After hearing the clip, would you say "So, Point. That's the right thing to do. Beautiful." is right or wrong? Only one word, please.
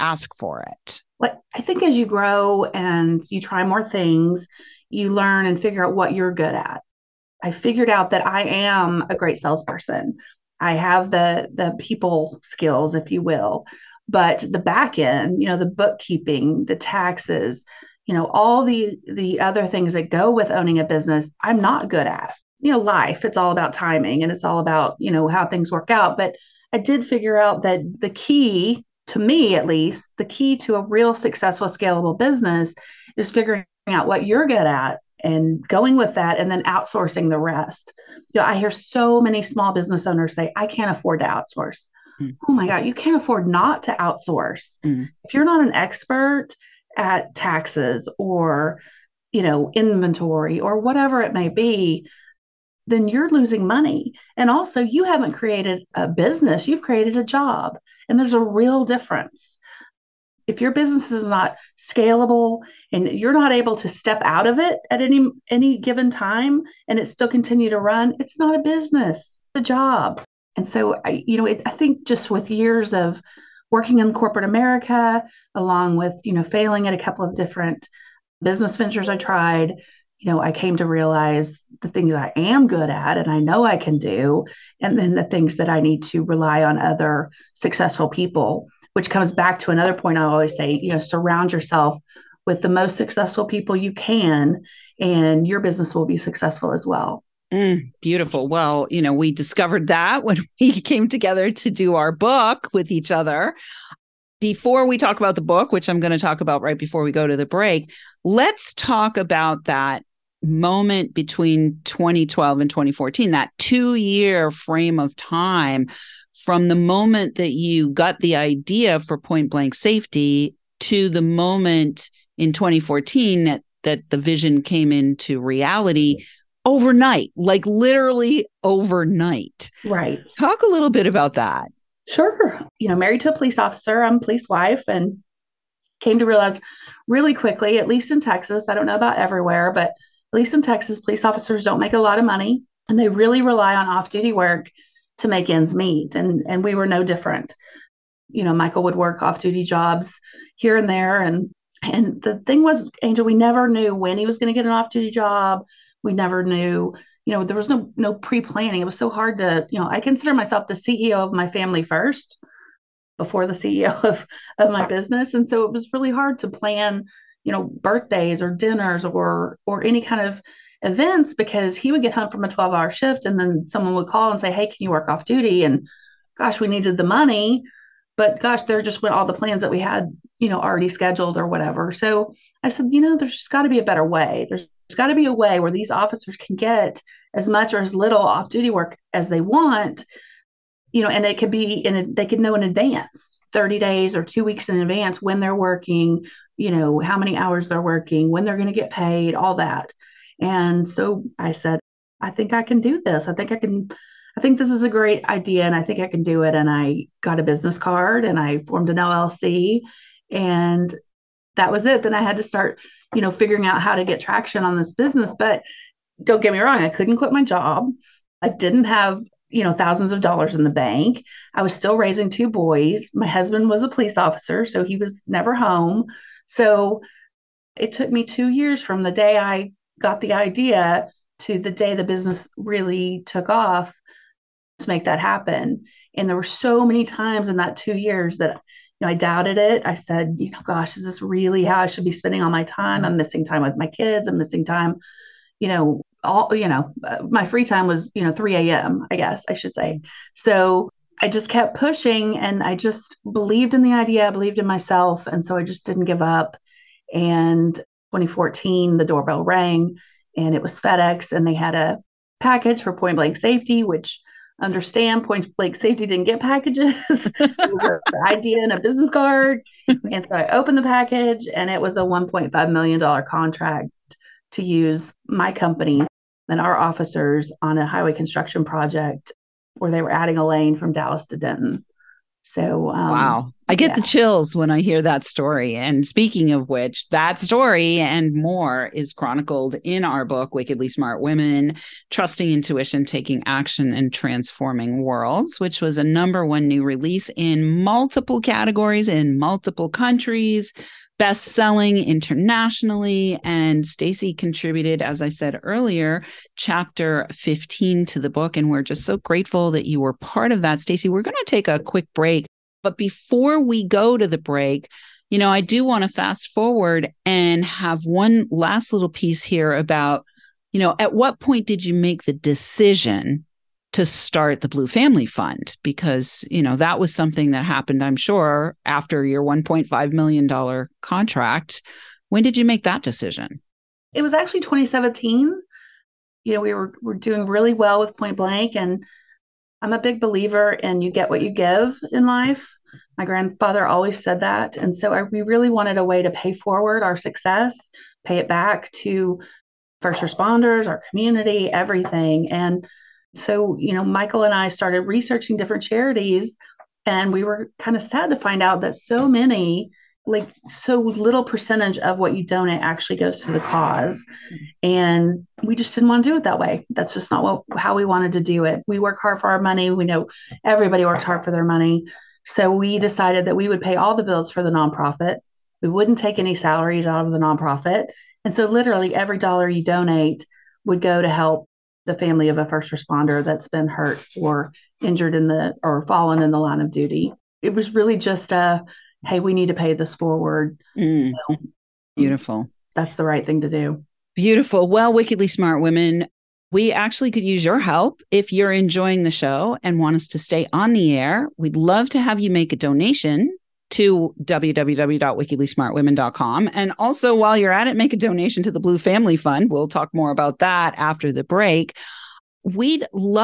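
wrong.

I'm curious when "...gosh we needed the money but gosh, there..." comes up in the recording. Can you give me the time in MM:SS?
02:56.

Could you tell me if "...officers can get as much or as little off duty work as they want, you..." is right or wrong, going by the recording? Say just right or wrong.
right.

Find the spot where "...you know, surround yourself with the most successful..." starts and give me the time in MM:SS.
01:30.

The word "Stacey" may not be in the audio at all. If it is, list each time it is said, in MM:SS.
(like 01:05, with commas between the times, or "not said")
05:03, 05:10.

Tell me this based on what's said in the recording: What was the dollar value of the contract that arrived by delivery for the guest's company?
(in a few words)
$1.5 million.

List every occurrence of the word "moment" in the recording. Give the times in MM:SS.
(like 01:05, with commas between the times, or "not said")
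01:50, 01:56, 02:01.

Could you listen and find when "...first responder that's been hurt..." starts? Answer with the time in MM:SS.
06:22.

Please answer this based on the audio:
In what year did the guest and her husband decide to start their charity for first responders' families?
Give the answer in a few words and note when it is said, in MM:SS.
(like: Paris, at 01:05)
2017, at 05:34.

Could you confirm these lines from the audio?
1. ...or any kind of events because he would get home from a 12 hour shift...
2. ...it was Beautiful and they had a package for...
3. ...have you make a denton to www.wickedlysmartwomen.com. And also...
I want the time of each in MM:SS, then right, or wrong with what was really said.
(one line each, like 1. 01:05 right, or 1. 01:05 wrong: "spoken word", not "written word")
1. 02:49 right
2. 04:20 wrong: "FedEx", not "Beautiful"
3. 06:42 wrong: "donation", not "denton".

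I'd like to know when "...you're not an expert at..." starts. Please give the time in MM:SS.
00:45.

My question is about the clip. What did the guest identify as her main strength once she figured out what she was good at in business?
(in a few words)
salesperson.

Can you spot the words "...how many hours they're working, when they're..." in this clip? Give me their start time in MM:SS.
03:16.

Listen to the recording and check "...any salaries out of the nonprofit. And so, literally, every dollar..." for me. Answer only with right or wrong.
right.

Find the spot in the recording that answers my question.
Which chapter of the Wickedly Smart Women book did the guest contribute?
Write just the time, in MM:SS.
05:06.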